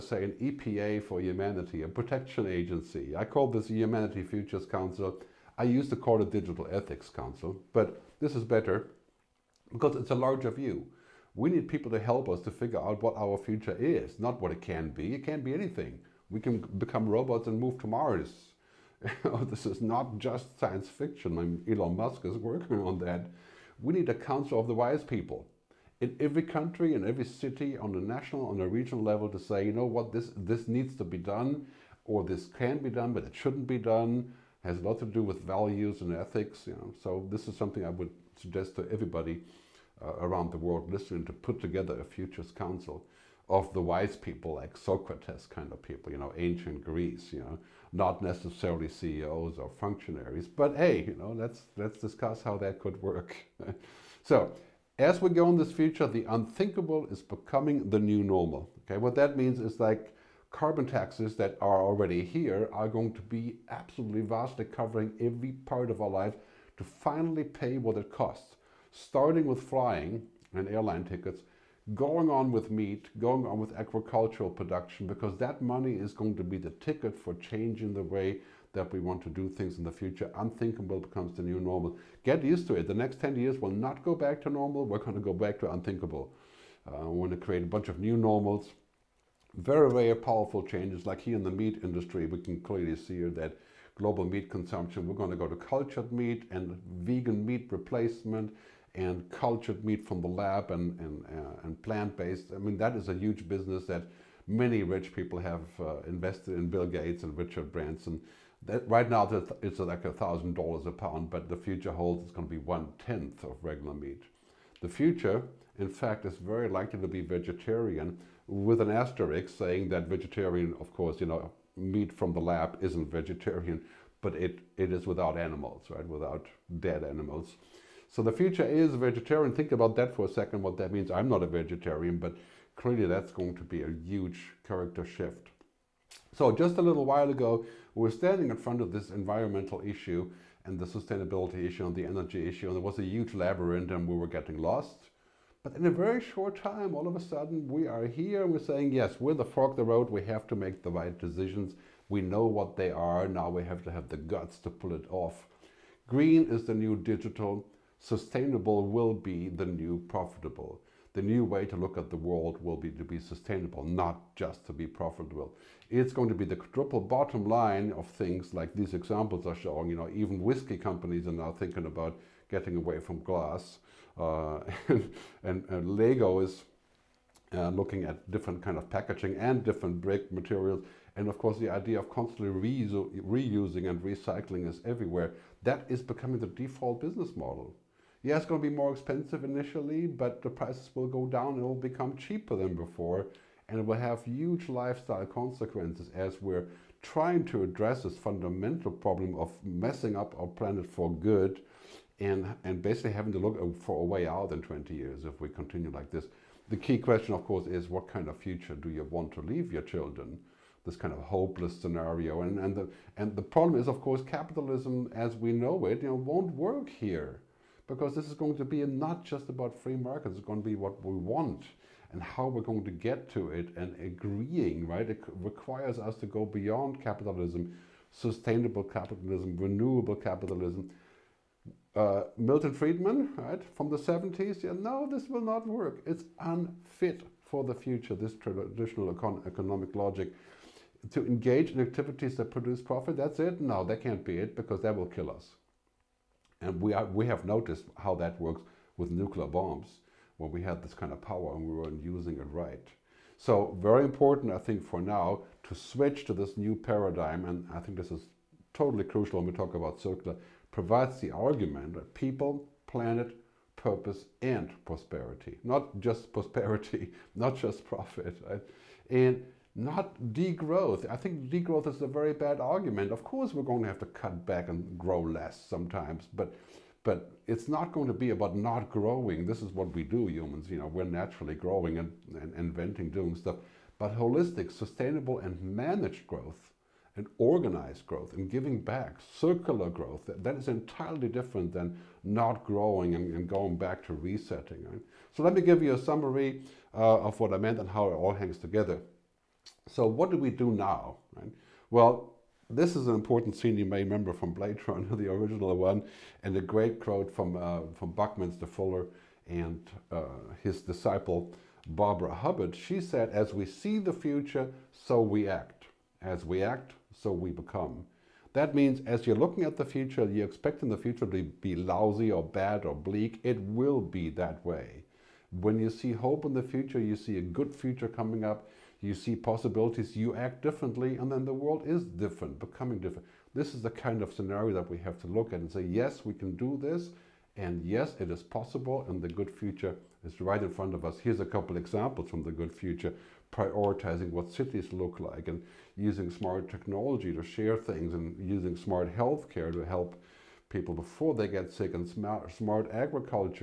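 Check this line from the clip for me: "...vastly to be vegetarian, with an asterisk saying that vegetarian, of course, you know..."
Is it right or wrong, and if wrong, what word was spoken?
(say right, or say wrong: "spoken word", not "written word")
wrong: "likely", not "vastly".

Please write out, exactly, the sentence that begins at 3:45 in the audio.
It requires us to go beyond capitalism, sustainable capitalism, renewable capitalism uh, Milton Friedman, right, from the 70s.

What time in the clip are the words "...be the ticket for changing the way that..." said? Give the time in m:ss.
1:16.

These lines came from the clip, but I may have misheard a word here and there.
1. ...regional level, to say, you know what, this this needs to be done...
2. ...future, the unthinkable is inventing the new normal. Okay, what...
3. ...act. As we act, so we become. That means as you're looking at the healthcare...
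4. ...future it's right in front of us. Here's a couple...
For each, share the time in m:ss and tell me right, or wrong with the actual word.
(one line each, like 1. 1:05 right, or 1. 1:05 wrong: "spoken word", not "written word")
1. 0:28 right
2. 0:55 wrong: "becoming", not "inventing"
3. 5:15 wrong: "future", not "healthcare"
4. 5:39 right.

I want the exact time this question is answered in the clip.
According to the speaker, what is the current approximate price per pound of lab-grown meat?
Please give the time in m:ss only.
1:50.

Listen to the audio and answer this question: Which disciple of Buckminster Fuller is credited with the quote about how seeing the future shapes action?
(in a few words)
Barbara Hubbard.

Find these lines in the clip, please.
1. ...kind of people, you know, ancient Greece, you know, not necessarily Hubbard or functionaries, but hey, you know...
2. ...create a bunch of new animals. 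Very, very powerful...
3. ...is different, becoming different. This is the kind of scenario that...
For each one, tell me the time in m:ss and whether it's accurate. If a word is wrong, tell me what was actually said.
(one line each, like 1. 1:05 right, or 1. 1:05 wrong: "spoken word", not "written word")
1. 0:45 wrong: "CEOs", not "Hubbard"
2. 1:27 wrong: "normals", not "animals"
3. 5:31 right.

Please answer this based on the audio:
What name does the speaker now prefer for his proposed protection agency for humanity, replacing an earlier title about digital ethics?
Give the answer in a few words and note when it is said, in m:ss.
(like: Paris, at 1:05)
Humanity Futures Council, at 0:03.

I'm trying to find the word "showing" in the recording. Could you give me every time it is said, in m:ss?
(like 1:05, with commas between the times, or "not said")
2:49.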